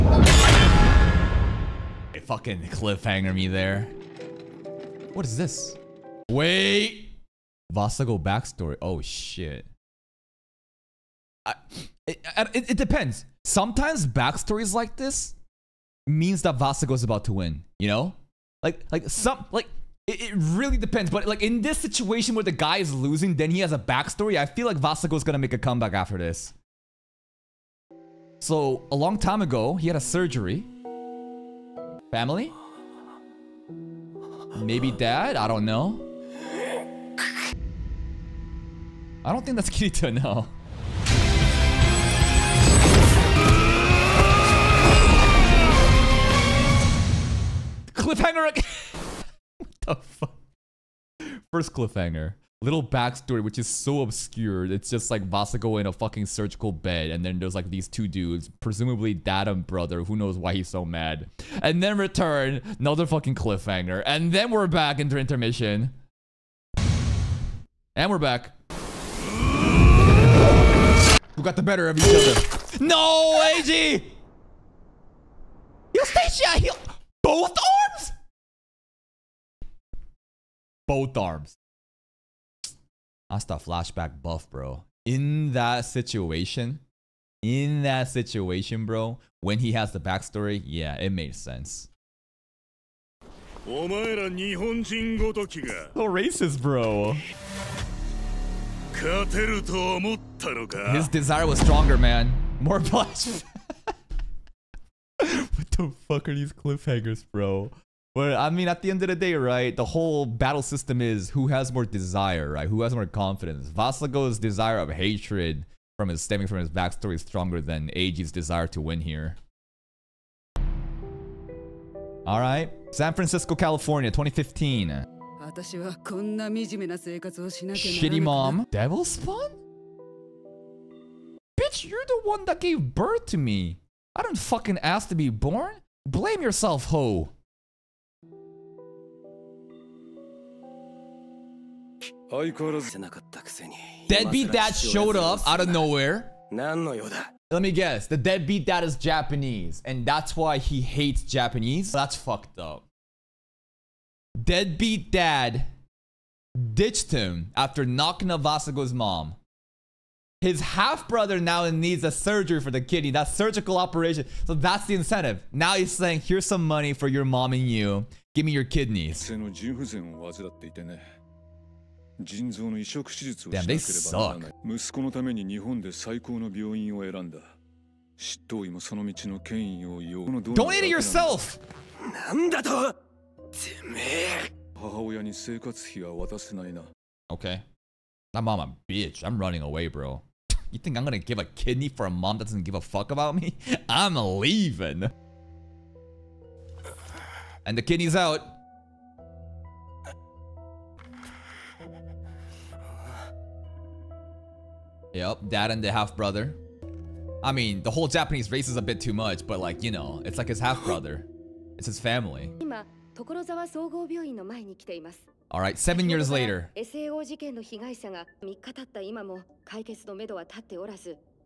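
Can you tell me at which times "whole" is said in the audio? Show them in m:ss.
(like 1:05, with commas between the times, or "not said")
1:49, 3:27.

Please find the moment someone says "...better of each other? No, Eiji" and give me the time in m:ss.
1:11.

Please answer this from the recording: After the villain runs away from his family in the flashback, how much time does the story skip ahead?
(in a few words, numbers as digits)
7 years.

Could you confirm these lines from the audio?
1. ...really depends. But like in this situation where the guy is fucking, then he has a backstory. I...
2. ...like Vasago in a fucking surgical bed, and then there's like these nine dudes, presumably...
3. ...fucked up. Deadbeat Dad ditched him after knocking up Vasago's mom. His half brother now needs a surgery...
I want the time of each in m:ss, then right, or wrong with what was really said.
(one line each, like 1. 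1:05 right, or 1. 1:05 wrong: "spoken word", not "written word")
1. 0:20 wrong: "losing", not "fucking"
2. 0:55 wrong: "two", not "nine"
3. 2:32 right.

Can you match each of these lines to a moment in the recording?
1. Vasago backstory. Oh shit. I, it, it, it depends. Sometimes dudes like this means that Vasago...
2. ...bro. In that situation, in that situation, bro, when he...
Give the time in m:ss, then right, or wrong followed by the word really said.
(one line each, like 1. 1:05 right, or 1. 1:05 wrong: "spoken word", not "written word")
1. 0:07 wrong: "backstories", not "dudes"
2. 1:24 right.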